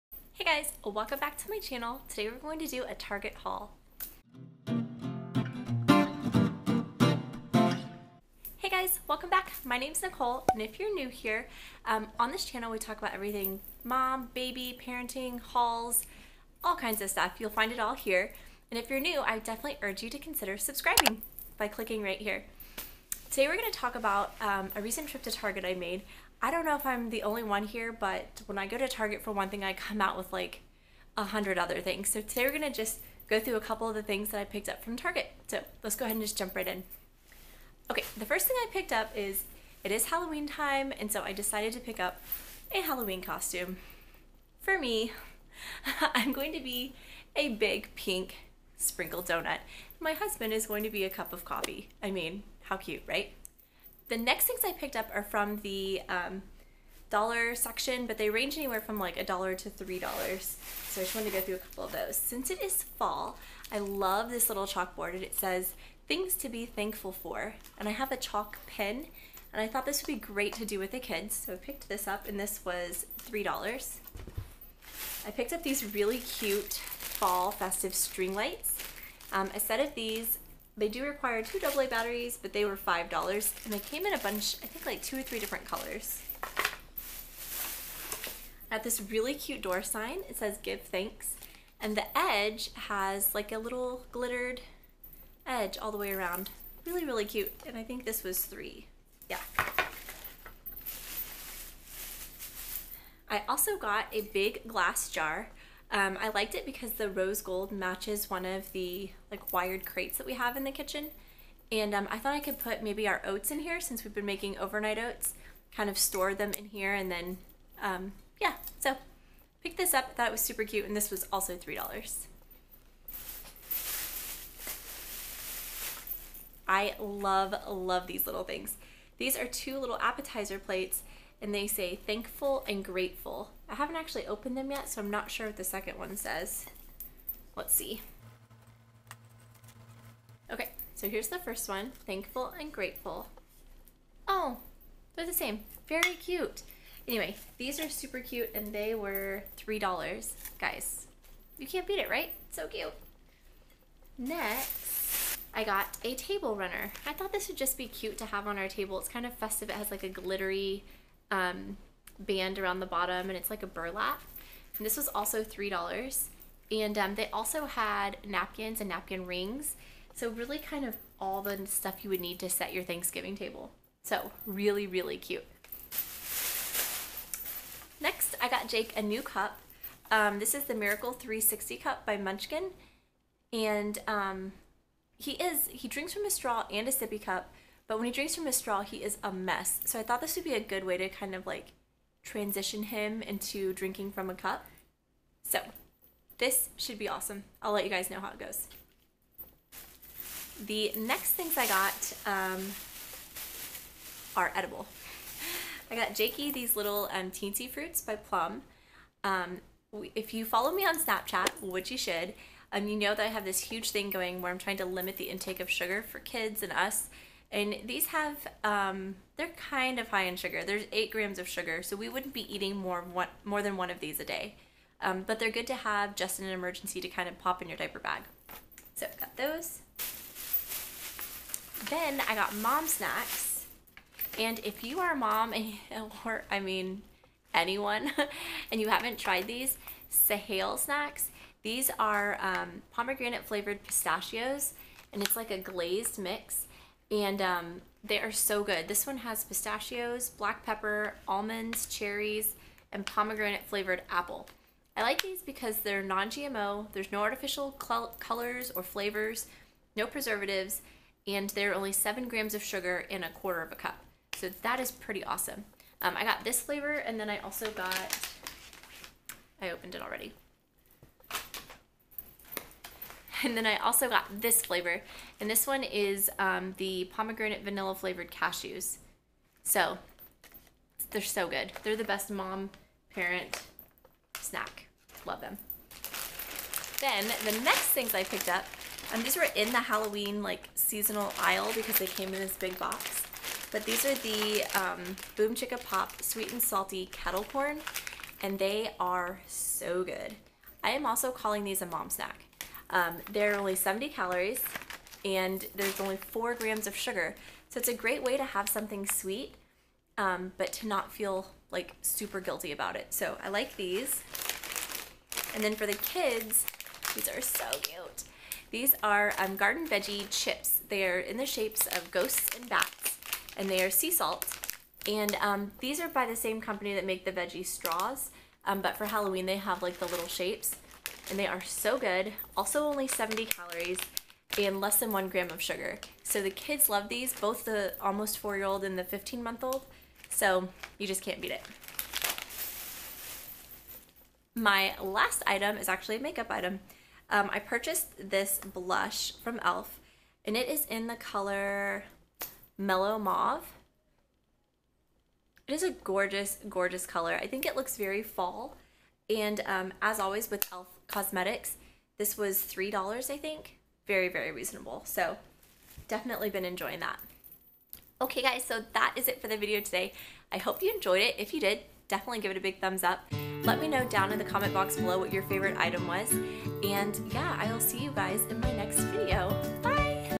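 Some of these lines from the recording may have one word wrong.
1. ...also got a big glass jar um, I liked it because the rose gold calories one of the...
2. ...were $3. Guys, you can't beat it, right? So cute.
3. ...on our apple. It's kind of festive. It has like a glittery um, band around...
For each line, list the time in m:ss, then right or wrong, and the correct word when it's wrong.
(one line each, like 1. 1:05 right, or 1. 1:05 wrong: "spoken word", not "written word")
1. 1:43 wrong: "matches", not "calories"
2. 2:28 right
3. 2:38 wrong: "table", not "apple".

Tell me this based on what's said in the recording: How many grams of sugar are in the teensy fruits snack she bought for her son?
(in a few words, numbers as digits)
8 grams.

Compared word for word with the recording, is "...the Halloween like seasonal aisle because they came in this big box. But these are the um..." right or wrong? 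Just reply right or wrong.
right.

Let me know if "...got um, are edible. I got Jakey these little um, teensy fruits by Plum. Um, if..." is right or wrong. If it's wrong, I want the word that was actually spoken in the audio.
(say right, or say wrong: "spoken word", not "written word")
right.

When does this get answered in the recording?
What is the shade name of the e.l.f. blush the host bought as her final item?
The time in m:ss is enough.
5:52.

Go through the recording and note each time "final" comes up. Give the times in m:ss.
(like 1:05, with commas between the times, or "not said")
not said.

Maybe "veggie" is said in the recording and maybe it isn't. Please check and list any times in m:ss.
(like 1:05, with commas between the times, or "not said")
5:19, 5:27.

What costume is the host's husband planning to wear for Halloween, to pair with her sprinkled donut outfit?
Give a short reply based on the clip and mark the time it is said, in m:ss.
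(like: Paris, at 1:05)
A cup of coffee, at 0:51.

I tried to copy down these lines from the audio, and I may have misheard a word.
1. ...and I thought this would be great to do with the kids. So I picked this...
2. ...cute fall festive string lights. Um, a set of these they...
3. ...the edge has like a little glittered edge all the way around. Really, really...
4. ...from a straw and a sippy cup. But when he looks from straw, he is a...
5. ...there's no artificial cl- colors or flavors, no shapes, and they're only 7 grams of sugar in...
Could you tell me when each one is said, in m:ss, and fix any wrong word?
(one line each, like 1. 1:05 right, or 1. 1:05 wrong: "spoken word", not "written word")
1. 1:09 right
2. 1:16 right
3. 1:31 right
4. 3:06 wrong: "drinks", not "looks"
5. 4:16 wrong: "preservatives", not "shapes".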